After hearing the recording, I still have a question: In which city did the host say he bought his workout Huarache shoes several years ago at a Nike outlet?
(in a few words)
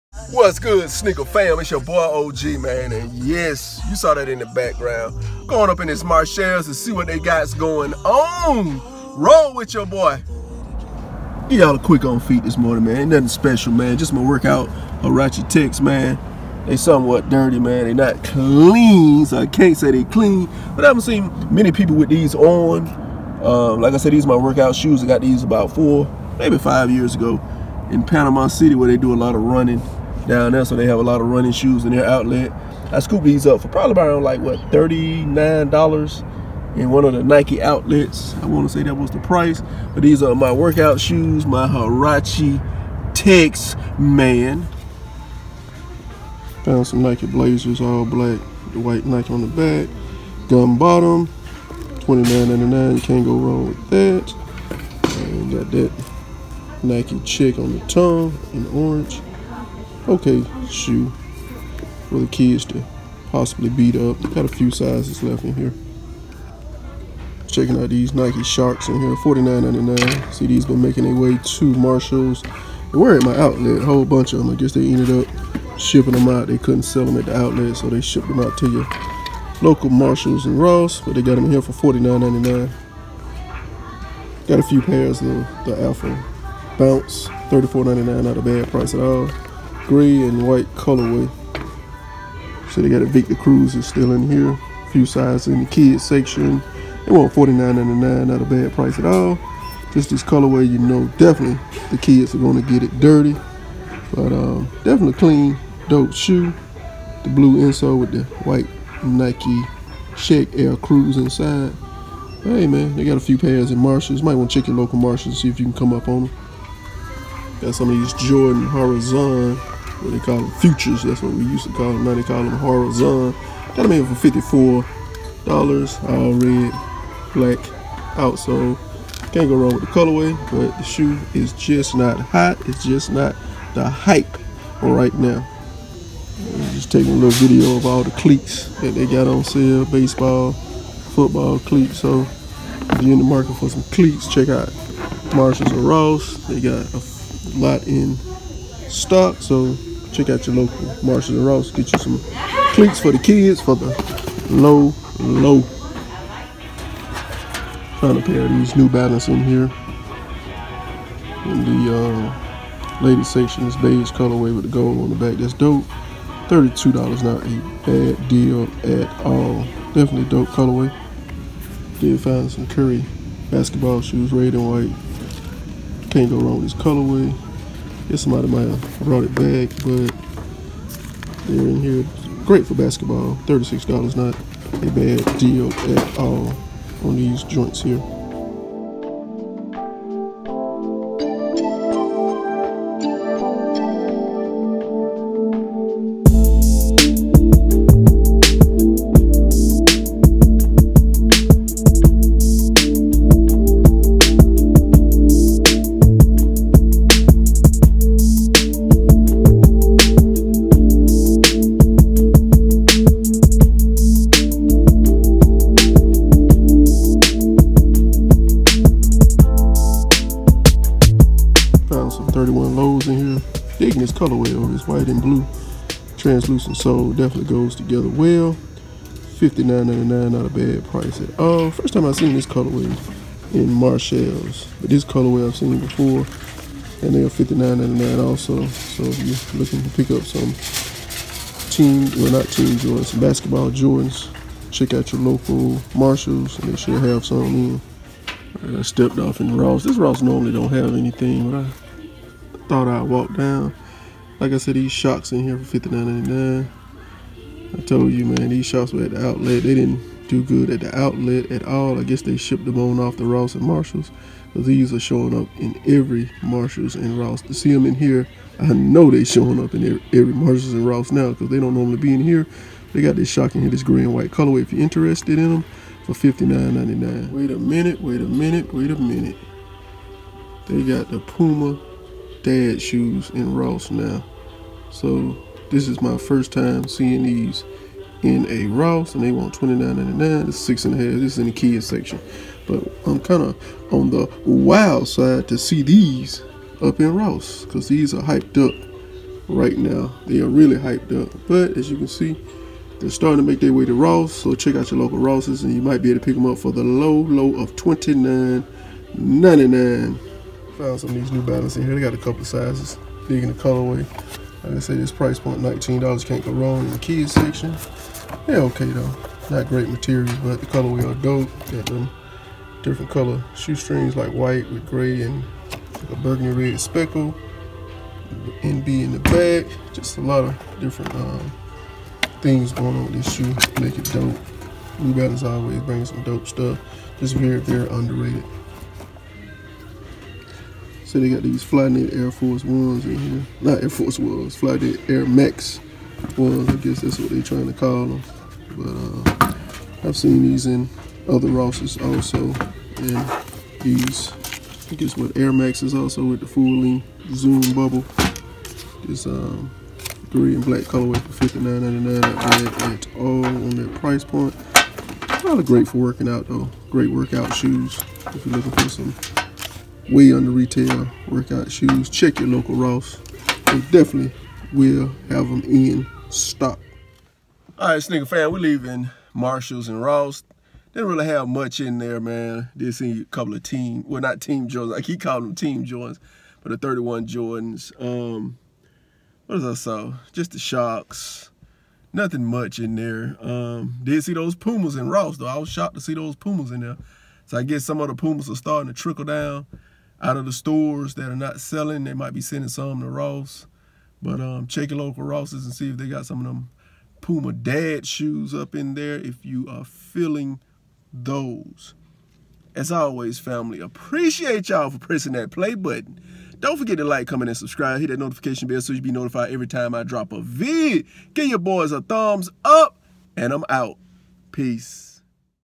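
Panama City.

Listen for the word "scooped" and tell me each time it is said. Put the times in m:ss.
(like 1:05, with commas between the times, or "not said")
0:32.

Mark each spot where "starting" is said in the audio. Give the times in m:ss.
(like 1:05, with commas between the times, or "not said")
5:03, 6:38.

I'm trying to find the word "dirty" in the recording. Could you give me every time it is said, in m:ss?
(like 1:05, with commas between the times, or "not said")
0:17, 1:43.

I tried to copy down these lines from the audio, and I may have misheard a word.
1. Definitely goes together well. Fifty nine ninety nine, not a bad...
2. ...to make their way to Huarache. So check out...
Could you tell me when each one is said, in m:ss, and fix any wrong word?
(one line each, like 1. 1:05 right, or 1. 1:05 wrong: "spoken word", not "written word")
1. 3:47 right
2. 5:03 wrong: "Ross", not "Huarache".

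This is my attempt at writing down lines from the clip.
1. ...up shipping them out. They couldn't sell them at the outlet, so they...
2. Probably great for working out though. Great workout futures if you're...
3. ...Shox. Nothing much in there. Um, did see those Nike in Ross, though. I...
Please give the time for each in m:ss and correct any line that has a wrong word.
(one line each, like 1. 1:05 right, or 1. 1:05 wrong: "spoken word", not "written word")
1. 1:15 right
2. 6:05 wrong: "shoes", not "futures"
3. 6:30 wrong: "Pumas", not "Nike".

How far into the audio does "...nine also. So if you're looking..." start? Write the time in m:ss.
3:58.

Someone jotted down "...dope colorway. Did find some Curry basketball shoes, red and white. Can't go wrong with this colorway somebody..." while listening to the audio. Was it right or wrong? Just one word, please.
right.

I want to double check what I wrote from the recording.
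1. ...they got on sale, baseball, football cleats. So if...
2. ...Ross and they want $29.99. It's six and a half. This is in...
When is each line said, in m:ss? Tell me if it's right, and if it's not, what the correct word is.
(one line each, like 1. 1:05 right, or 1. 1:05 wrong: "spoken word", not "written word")
1. 2:18 right
2. 4:48 right.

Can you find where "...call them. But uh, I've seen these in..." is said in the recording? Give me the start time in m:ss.
5:47.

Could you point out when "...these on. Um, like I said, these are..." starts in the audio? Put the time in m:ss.
0:22.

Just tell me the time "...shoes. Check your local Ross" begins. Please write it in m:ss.
6:11.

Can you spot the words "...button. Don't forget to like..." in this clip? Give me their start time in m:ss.
6:55.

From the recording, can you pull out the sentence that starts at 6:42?
They might be sending some to Ross.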